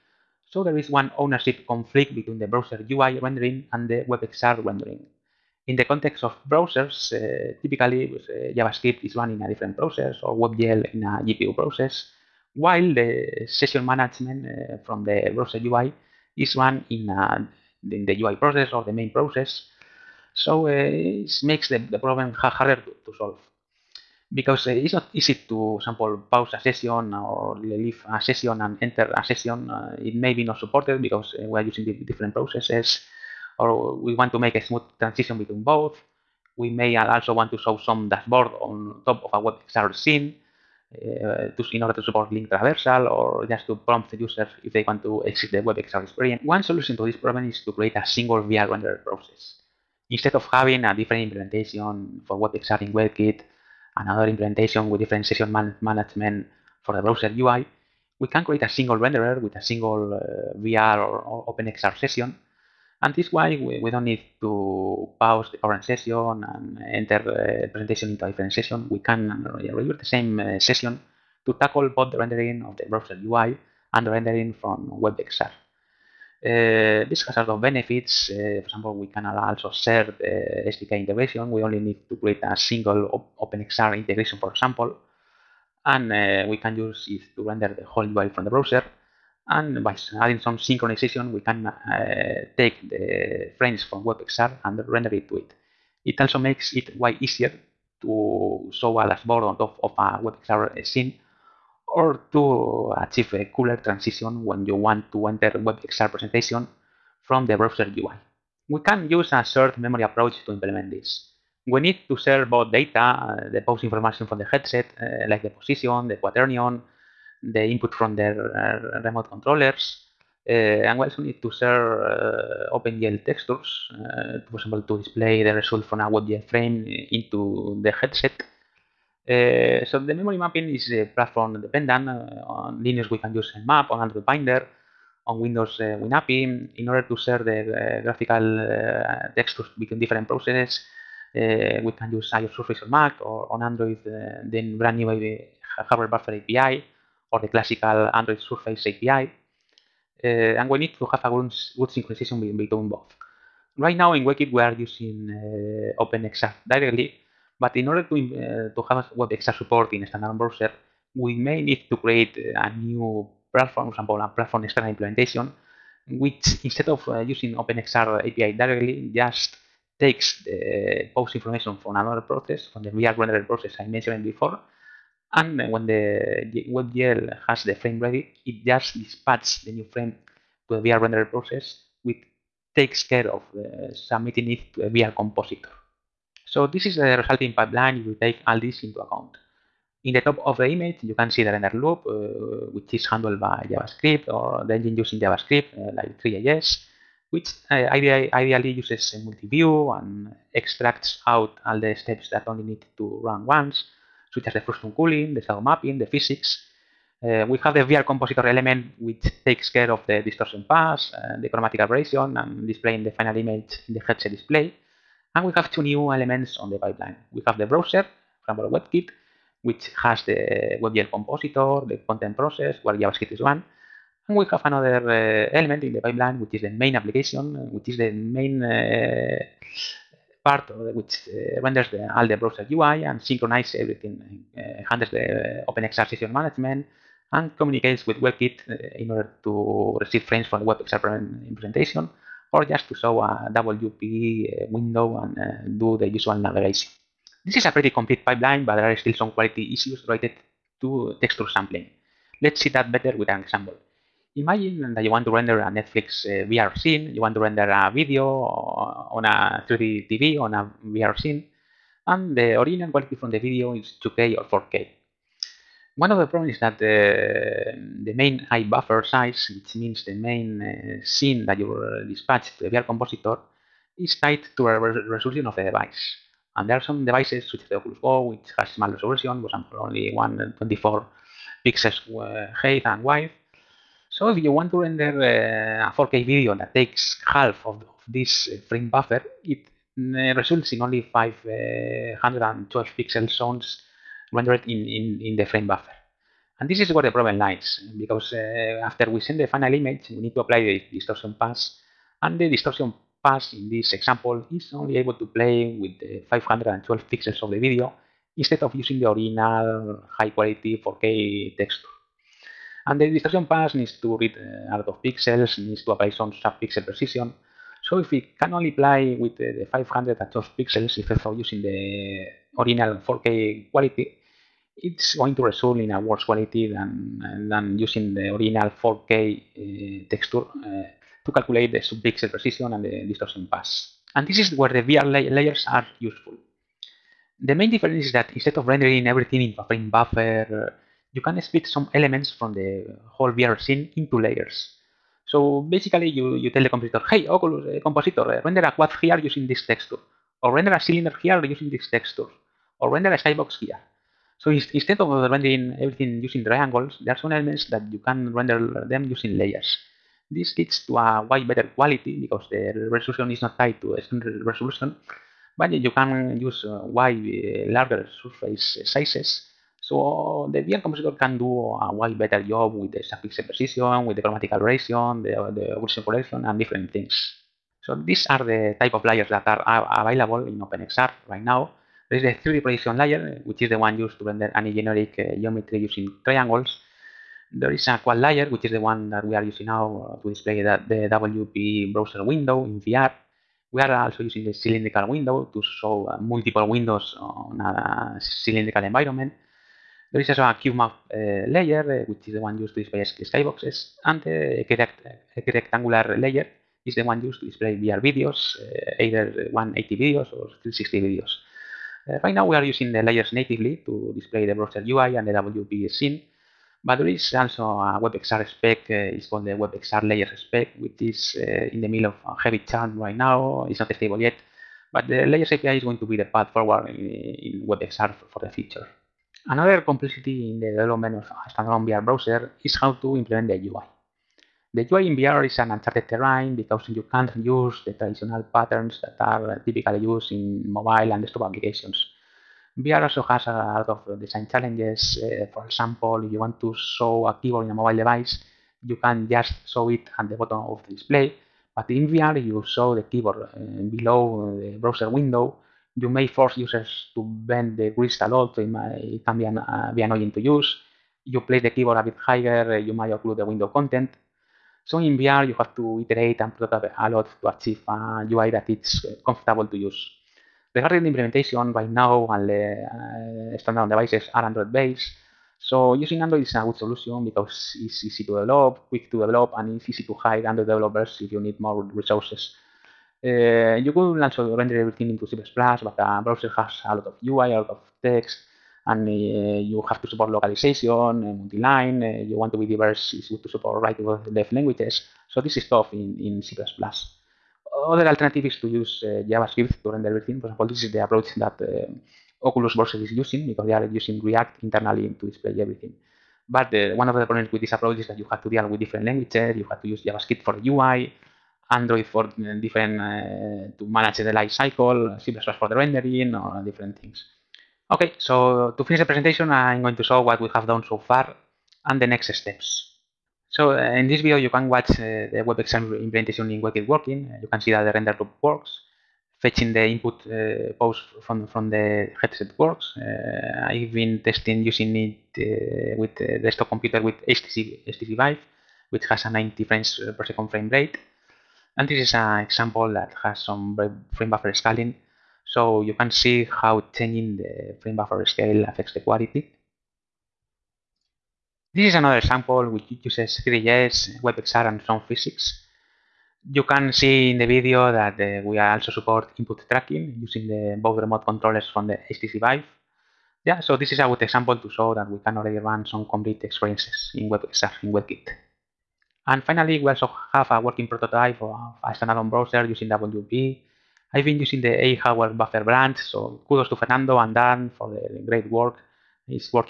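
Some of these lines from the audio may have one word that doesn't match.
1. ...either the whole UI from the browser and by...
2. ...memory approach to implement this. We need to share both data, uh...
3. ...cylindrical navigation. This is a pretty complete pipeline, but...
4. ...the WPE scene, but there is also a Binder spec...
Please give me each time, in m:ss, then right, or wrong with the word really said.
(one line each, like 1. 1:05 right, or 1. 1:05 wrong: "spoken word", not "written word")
1. 1:27 wrong: "render", not "either"
2. 1:49 right
3. 4:06 wrong: "usual", not "cylindrical"
4. 6:55 wrong: "WebXR", not "Binder".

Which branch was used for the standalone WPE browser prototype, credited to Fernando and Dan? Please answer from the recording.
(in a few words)
AHardwareBuffer.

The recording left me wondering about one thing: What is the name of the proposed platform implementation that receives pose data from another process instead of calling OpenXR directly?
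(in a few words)
platform external.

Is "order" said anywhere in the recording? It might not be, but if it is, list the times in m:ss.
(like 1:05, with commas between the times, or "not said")
0:41, 2:16, 2:37, 3:59.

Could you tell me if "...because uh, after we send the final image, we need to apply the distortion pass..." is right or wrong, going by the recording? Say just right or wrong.
right.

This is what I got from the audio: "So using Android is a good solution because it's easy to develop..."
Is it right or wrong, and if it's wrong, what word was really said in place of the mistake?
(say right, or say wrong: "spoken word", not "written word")
right.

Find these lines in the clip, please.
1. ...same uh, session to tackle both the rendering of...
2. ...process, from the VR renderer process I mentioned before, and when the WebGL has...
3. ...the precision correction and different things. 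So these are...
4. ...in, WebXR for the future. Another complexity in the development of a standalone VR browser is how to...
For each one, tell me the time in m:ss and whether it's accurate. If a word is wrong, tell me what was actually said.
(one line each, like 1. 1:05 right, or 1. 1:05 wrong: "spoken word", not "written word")
1. 1:10 right
2. 2:52 right
3. 6:15 wrong: "occlusion", not "precision"
4. 7:06 right.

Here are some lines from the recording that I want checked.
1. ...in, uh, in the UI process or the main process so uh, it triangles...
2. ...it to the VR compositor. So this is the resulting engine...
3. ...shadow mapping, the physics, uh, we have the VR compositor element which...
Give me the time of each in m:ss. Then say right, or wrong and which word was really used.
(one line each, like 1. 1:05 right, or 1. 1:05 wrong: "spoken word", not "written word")
1. 0:16 wrong: "makes", not "triangles"
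2. 3:04 wrong: "pipeline", not "engine"
3. 3:25 right.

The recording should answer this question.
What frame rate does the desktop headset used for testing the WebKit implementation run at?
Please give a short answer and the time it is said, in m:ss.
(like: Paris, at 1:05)
90 frames per second, at 8:59.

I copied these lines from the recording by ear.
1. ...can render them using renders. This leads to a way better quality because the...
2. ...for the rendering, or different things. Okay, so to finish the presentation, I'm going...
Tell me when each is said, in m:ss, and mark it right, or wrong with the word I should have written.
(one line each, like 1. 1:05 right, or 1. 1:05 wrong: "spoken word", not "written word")
1. 5:57 wrong: "layers", not "renders"
2. 8:35 right.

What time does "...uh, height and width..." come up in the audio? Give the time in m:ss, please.
4:42.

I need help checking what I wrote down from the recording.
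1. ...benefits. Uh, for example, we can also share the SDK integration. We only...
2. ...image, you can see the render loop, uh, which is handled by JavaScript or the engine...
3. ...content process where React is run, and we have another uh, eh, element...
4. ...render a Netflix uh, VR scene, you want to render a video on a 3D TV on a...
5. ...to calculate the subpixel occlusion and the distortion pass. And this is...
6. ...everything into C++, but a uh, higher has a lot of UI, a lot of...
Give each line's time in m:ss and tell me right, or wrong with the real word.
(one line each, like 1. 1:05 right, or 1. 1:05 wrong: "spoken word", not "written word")
1. 1:17 right
2. 3:10 right
3. 3:42 wrong: "JavaScript", not "React"
4. 4:15 right
5. 5:31 wrong: "precision", not "occlusion"
6. 8:04 wrong: "browser", not "higher".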